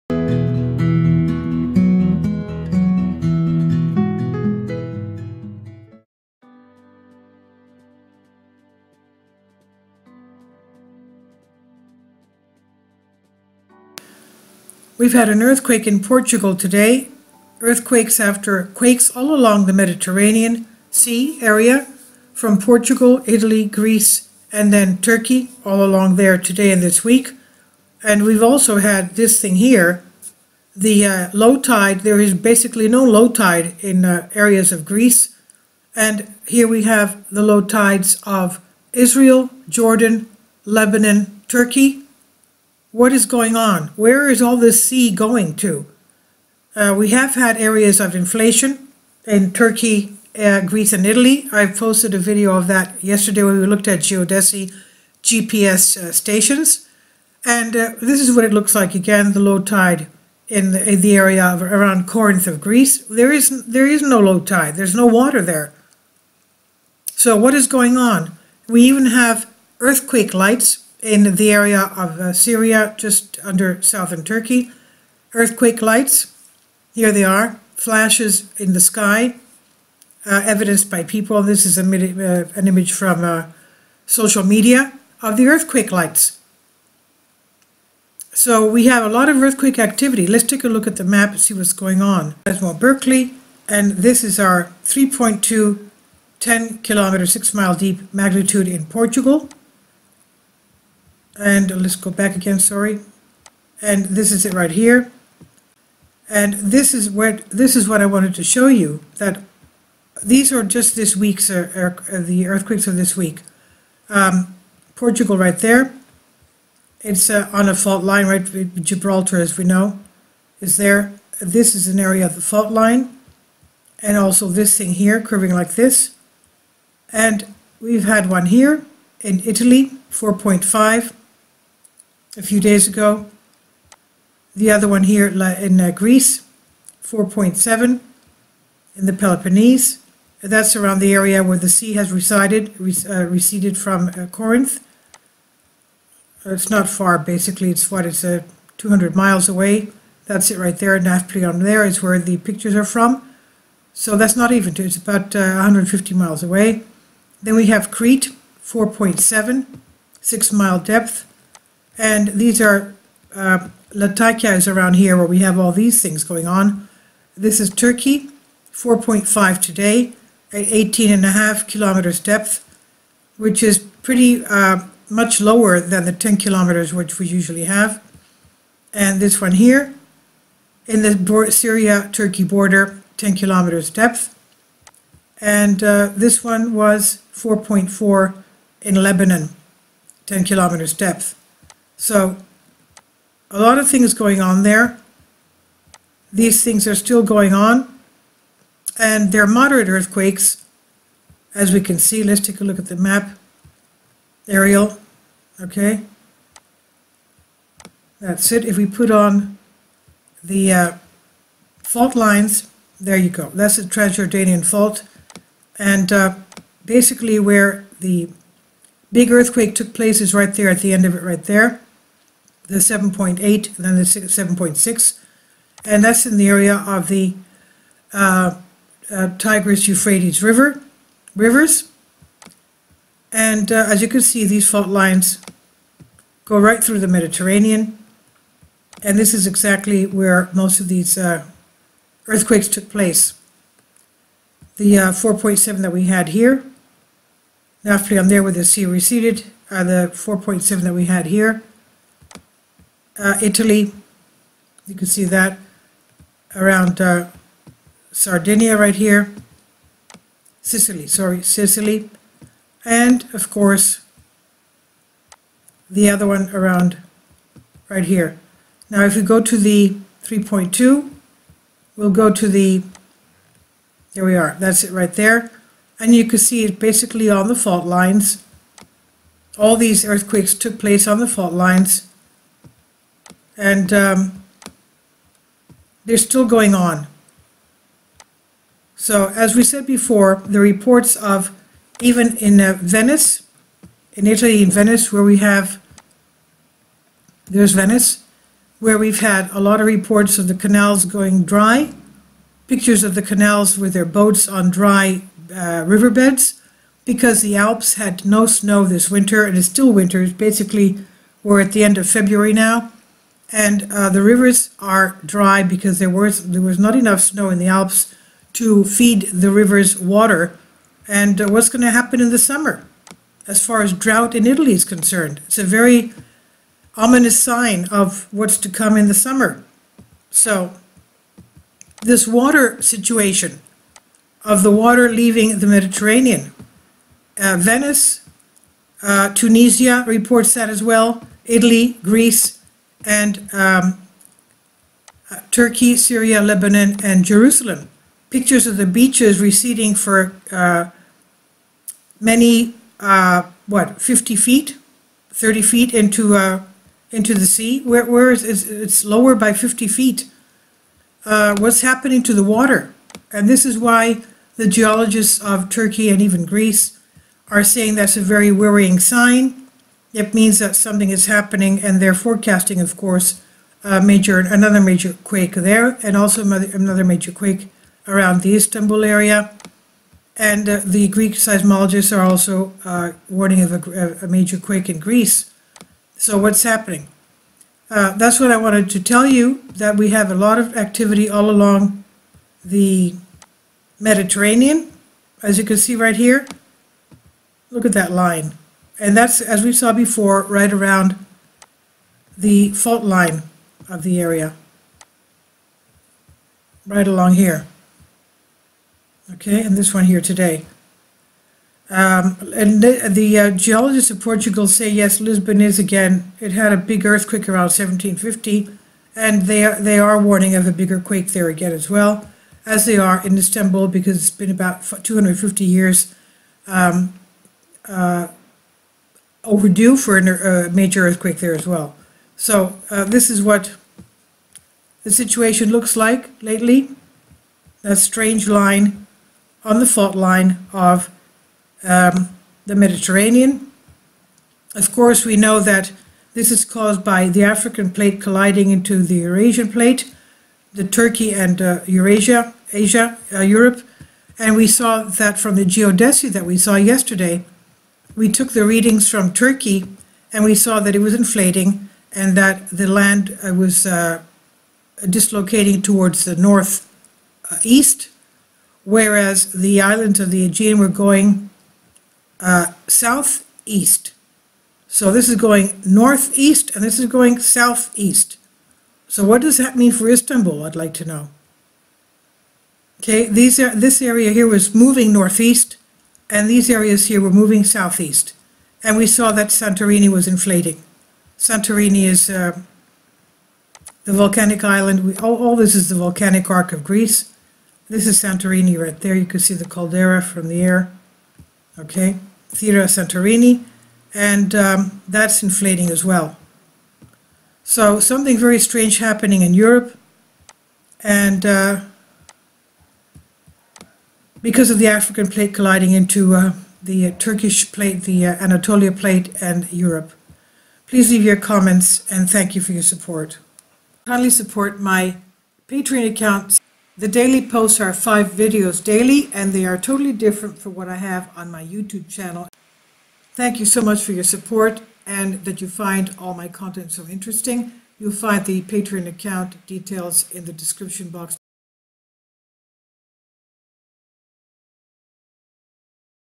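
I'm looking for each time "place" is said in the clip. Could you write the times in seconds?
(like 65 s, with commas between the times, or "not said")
219 s, 242 s, 280 s.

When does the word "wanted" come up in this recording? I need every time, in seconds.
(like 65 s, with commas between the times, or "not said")
108 s, 388 s.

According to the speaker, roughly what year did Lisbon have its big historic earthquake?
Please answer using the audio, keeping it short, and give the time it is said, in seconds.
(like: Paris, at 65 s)
1750, at 417 s.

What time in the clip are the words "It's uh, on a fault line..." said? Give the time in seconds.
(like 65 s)
117 s.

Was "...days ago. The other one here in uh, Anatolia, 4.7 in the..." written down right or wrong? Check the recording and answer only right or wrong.
wrong.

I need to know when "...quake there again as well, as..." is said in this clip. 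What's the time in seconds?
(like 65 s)
421 s.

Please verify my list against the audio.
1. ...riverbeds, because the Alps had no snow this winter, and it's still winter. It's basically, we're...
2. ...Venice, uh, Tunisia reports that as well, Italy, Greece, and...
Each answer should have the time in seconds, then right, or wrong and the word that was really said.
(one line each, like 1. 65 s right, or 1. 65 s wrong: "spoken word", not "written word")
1. 305 s right
2. 337 s right.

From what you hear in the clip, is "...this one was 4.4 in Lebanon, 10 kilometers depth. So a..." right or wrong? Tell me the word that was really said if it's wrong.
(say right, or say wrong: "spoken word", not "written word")
right.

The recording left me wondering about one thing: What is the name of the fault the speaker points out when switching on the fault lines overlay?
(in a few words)
Transjordanian fault.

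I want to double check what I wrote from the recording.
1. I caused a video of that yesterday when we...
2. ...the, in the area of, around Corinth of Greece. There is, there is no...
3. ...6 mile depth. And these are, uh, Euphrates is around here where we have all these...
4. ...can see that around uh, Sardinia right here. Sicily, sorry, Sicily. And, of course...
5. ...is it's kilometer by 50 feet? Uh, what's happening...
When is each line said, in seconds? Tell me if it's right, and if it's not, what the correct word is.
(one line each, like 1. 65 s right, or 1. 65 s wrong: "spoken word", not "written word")
1. 51 s wrong: "posted", not "caused"
2. 60 s right
3. 160 s wrong: "Latakia", not "Euphrates"
4. 254 s right
5. 358 s wrong: "lower", not "kilometer".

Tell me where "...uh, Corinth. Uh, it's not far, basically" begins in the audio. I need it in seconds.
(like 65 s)
144 s.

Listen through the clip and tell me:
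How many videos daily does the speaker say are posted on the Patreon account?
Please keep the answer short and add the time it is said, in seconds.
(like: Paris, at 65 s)
5, at 527 s.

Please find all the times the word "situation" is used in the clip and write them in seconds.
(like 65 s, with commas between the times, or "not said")
332 s, 435 s.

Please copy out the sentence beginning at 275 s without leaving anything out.
And you can see it basically on the fault lines.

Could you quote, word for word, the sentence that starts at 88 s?
So we have a lot of earthquake activity.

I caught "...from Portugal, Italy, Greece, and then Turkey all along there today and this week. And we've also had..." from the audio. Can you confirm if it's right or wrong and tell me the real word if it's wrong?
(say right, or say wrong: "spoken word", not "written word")
right.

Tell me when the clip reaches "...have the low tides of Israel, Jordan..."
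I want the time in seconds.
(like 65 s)
36 s.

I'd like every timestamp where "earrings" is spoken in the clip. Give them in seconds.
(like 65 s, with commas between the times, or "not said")
not said.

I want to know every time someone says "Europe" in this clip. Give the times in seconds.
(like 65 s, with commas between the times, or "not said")
453 s, 509 s, 519 s.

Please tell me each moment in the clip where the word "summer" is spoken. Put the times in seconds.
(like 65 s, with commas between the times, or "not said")
322 s, 329 s.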